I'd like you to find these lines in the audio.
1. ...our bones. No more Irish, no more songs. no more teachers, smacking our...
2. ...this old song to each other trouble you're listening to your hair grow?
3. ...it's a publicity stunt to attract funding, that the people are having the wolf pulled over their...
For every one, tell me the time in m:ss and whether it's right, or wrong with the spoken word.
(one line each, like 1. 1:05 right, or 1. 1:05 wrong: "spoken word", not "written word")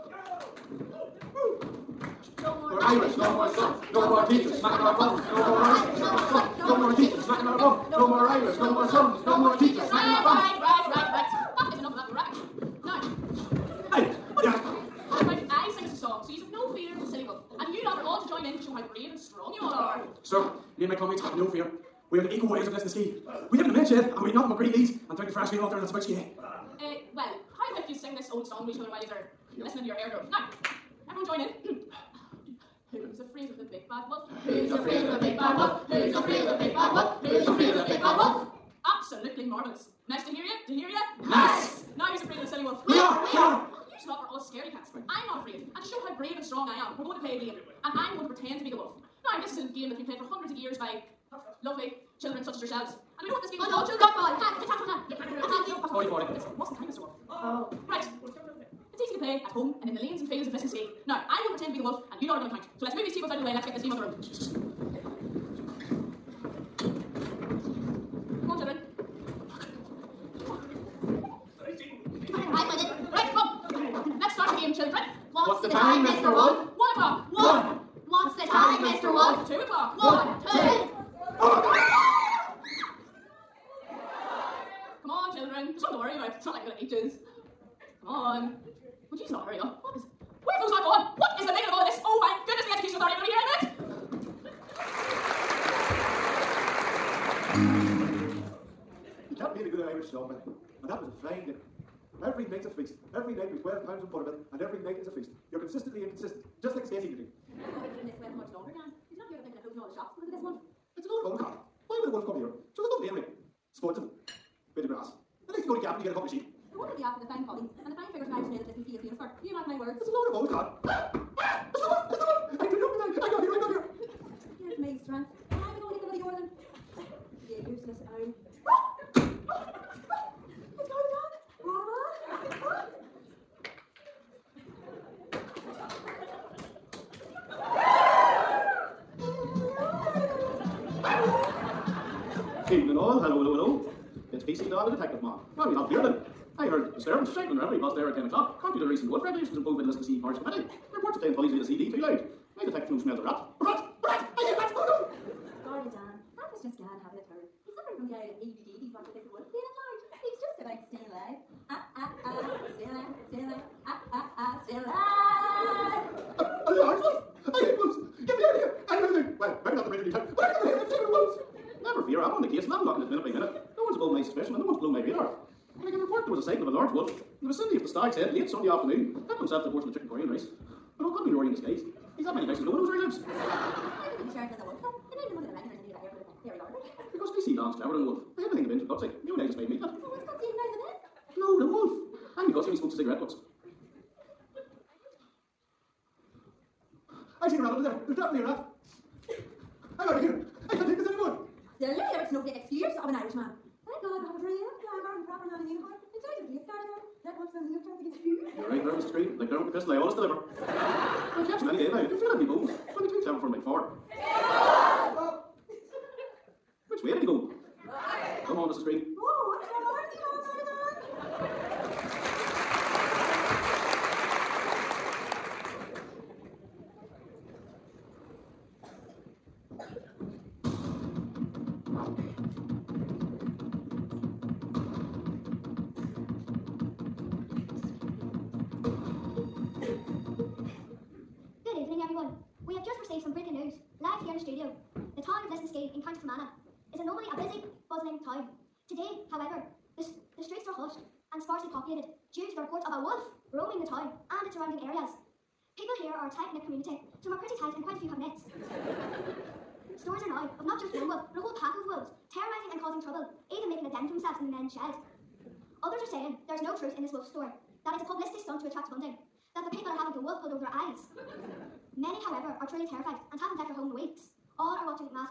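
1. 0:07 right
2. 0:28 wrong: "while", not "trouble"
3. 4:27 right.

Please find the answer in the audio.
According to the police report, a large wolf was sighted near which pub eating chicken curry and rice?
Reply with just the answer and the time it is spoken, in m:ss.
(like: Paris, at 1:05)
the Stag's Head, at 2:57.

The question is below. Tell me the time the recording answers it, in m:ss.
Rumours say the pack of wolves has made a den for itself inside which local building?
4:24.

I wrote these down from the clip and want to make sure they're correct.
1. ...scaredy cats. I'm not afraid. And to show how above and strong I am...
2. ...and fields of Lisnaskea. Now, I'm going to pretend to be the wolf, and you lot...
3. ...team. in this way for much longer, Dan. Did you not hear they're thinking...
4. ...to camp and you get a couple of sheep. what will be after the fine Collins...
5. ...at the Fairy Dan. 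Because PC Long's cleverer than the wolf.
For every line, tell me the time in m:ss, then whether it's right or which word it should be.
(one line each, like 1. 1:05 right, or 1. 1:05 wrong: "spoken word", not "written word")
1. 0:44 wrong: "brave", not "above"
2. 1:00 right
3. 1:47 right
4. 1:55 right
5. 3:06 wrong: "Barber", not "Dan".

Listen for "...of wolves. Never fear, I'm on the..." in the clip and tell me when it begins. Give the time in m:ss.
2:51.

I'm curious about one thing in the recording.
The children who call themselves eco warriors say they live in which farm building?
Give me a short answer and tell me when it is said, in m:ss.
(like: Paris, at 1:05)
the milk shed, at 0:23.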